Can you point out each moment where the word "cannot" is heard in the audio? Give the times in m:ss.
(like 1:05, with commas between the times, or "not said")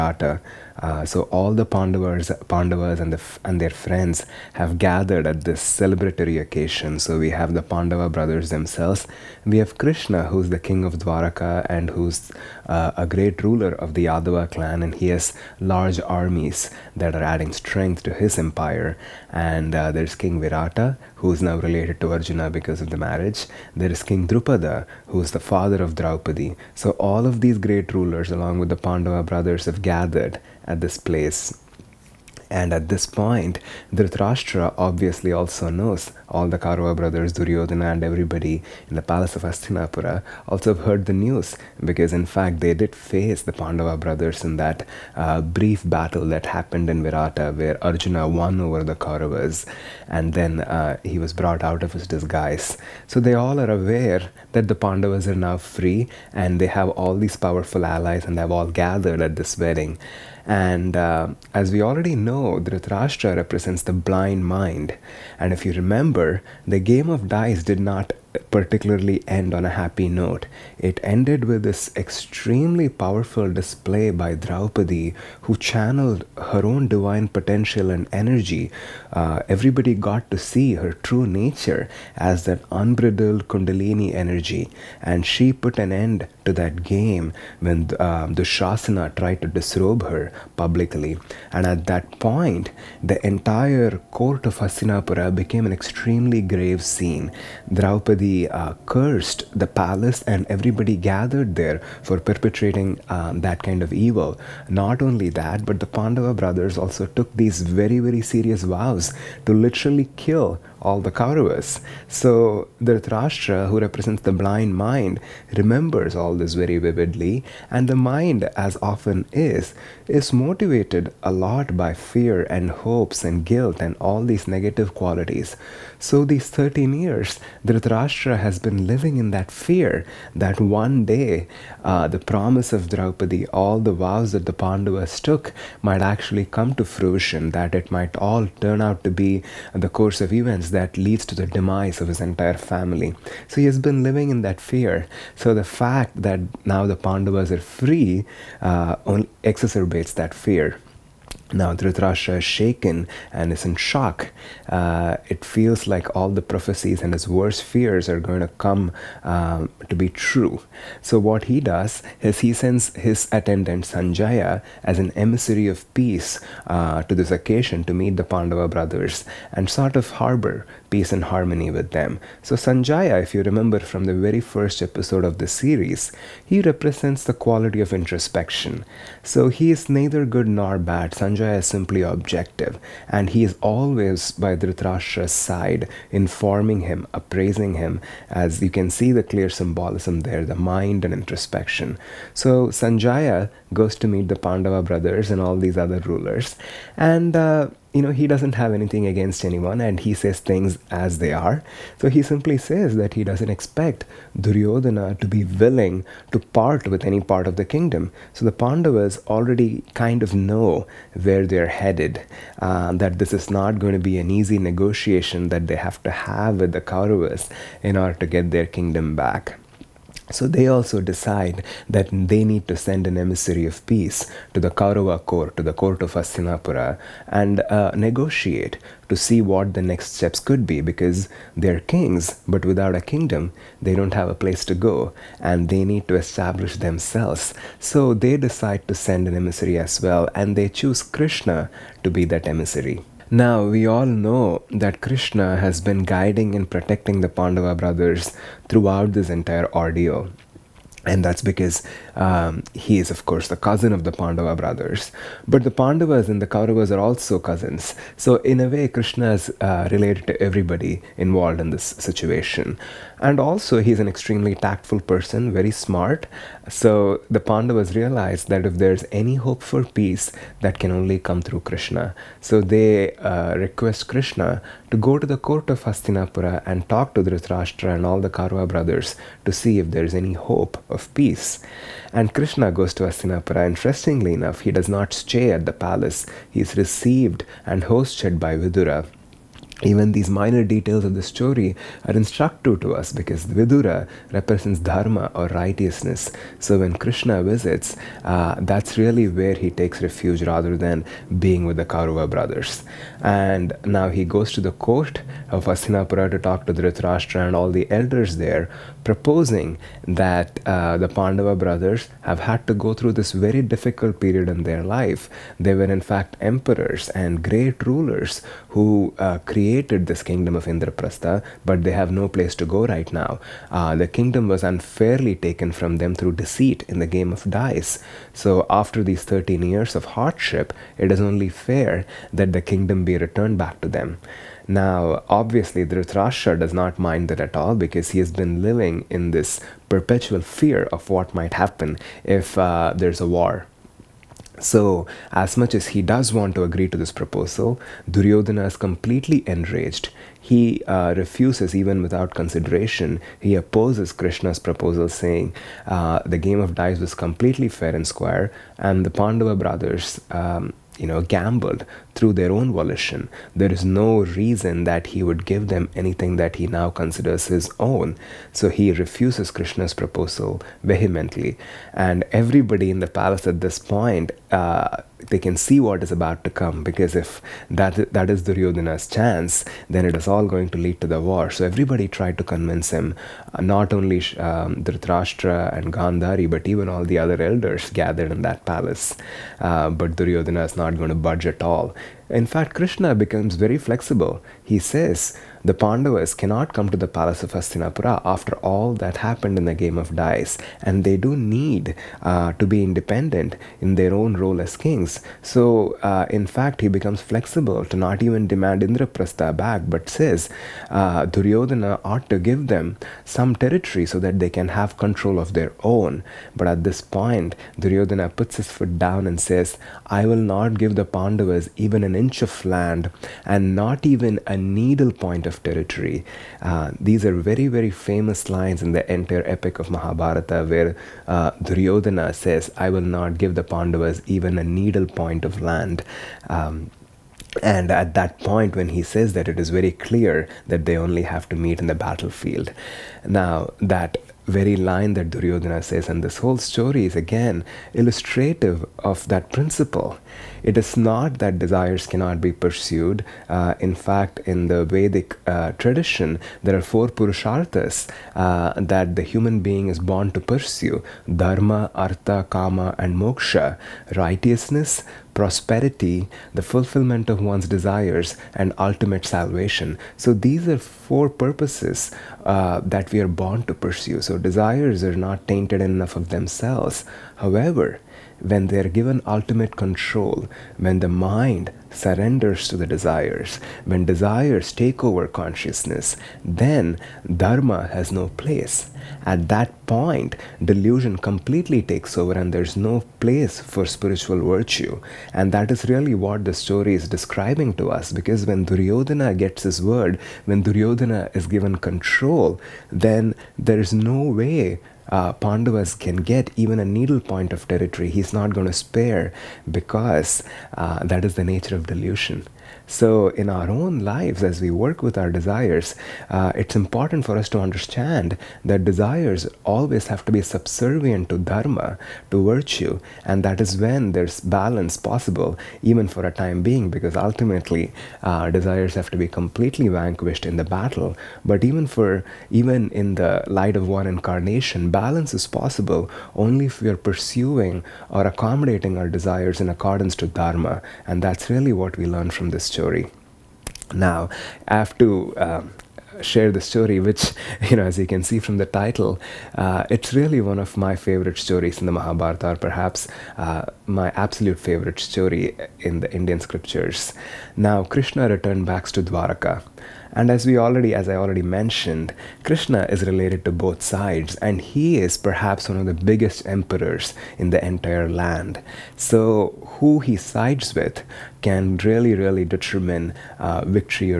6:36, 7:32.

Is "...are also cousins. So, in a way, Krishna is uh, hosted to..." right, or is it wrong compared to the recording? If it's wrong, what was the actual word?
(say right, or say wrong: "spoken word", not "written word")
wrong: "related", not "hosted".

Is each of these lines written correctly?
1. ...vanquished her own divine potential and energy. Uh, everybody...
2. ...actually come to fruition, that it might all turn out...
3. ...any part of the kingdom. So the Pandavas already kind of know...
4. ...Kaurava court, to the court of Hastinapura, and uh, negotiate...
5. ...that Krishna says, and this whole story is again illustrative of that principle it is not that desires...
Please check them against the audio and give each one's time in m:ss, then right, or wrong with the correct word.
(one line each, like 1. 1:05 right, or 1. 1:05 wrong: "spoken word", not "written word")
1. 1:15 wrong: "channeled", not "vanquished"
2. 2:16 right
3. 3:27 right
4. 3:44 right
5. 7:25 wrong: "Duryodhana", not "Krishna".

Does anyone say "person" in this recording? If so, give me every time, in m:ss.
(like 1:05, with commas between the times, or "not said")
4:24.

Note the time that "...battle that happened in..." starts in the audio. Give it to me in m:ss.
0:45.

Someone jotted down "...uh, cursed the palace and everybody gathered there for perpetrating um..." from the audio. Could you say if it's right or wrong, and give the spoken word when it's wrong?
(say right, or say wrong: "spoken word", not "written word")
right.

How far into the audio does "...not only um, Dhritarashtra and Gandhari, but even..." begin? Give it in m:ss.
6:23.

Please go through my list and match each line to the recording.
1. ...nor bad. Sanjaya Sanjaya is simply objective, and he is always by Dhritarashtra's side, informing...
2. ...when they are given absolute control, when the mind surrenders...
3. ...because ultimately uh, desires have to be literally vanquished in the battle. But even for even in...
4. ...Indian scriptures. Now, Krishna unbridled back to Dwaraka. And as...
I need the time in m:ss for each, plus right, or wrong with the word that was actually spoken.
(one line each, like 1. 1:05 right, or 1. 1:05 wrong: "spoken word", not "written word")
1. 3:00 right
2. 7:58 wrong: "ultimate", not "absolute"
3. 8:46 wrong: "completely", not "literally"
4. 9:16 wrong: "returned", not "unbridled".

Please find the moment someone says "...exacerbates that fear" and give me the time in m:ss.
2:29.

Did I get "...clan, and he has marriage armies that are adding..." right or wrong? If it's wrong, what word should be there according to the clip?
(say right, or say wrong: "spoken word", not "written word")
wrong: "large", not "marriage".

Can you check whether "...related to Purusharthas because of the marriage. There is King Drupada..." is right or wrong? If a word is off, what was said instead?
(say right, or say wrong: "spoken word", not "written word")
wrong: "Arjuna", not "Purusharthas".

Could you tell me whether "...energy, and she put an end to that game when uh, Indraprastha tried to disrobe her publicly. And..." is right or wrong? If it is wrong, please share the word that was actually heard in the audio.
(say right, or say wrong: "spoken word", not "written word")
wrong: "Shasana", not "Indraprastha".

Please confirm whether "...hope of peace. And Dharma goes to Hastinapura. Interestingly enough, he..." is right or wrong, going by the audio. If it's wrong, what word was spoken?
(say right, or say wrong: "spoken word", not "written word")
wrong: "Krishna", not "Dharma".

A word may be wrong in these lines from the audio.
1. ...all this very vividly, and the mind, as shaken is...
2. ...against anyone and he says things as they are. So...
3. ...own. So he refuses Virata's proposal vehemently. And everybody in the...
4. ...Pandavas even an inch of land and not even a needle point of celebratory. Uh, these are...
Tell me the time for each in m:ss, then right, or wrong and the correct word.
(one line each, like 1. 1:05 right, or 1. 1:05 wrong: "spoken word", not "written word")
1. 1:56 wrong: "often", not "shaken"
2. 3:19 right
3. 6:07 wrong: "Krishna", not "Virata"
4. 7:01 wrong: "territory", not "celebratory".